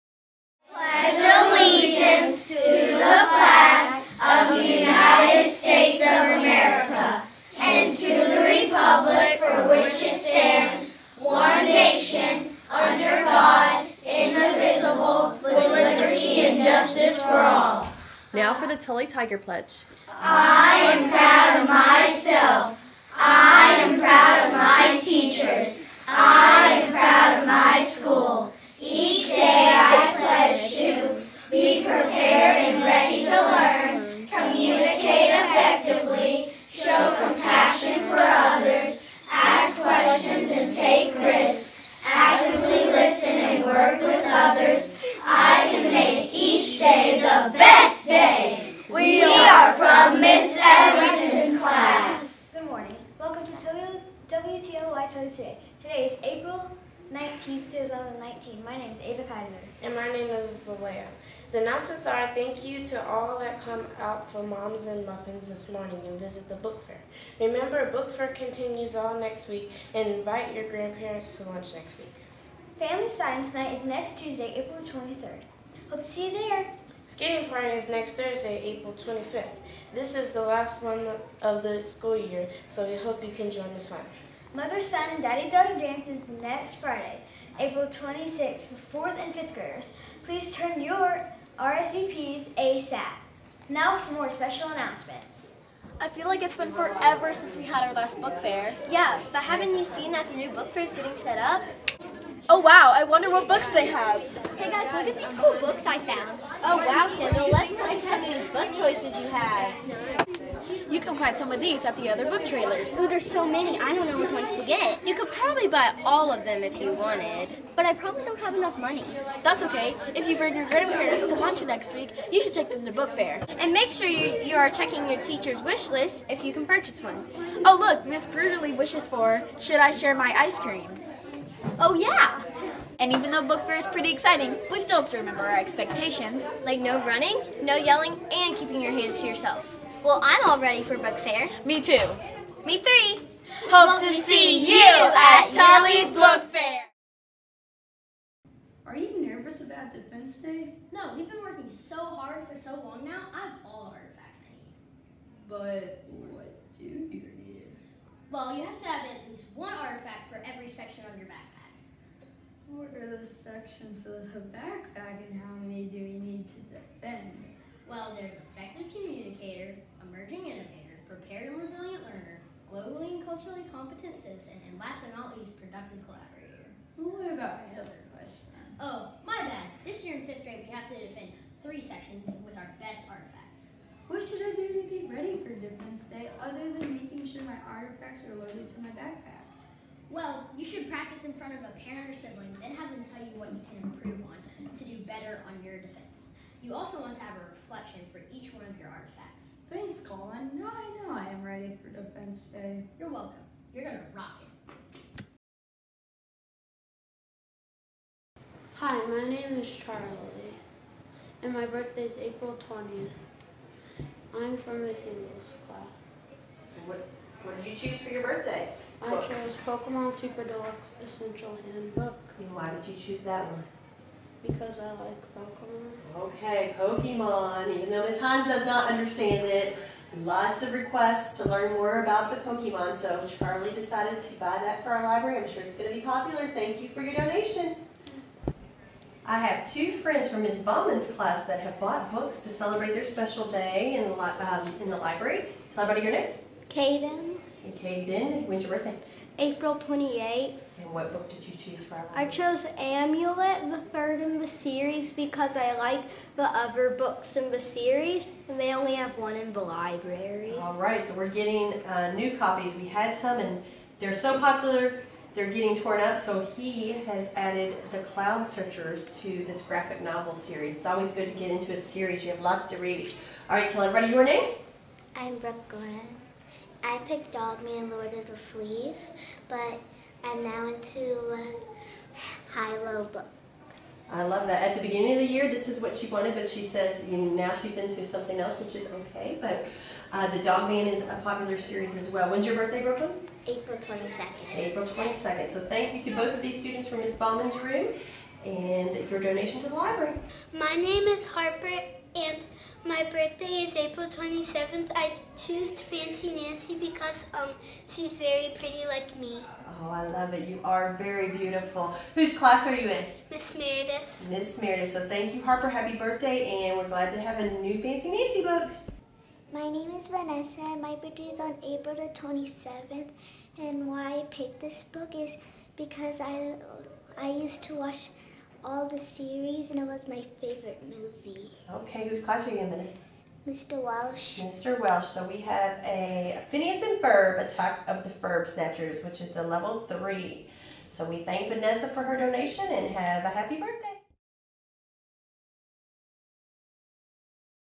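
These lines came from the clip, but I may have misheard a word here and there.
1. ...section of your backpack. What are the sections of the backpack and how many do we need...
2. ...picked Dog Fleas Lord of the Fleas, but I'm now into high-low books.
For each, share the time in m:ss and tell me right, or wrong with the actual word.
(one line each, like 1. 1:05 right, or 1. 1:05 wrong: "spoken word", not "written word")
1. 2:40 right
2. 4:36 wrong: "Man", not "Fleas".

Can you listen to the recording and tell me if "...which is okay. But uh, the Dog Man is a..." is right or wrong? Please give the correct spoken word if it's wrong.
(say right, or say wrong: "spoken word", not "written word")
right.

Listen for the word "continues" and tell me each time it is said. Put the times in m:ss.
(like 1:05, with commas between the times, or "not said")
1:08.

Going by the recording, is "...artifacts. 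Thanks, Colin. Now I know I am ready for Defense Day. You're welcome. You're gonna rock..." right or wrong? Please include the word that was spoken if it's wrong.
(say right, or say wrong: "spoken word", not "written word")
right.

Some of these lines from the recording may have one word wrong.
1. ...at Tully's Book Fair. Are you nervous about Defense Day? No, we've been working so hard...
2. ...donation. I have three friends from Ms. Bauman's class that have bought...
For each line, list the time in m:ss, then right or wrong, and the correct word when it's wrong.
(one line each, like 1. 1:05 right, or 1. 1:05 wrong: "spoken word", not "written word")
1. 2:25 right
2. 3:57 wrong: "two", not "three".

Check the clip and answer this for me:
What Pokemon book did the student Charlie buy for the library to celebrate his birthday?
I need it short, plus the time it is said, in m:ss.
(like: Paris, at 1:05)
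Pokemon Super Deluxe Essential Handbook, at 3:39.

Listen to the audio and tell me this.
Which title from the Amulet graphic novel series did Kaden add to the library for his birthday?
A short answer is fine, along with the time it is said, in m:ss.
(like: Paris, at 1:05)
Cloud Searchers, at 4:27.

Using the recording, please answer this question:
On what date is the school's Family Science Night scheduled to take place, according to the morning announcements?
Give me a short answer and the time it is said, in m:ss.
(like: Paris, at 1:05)
April 23rd, at 1:14.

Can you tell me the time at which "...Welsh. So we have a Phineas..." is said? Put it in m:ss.
5:34.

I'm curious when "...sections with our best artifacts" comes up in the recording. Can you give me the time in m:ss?
3:01.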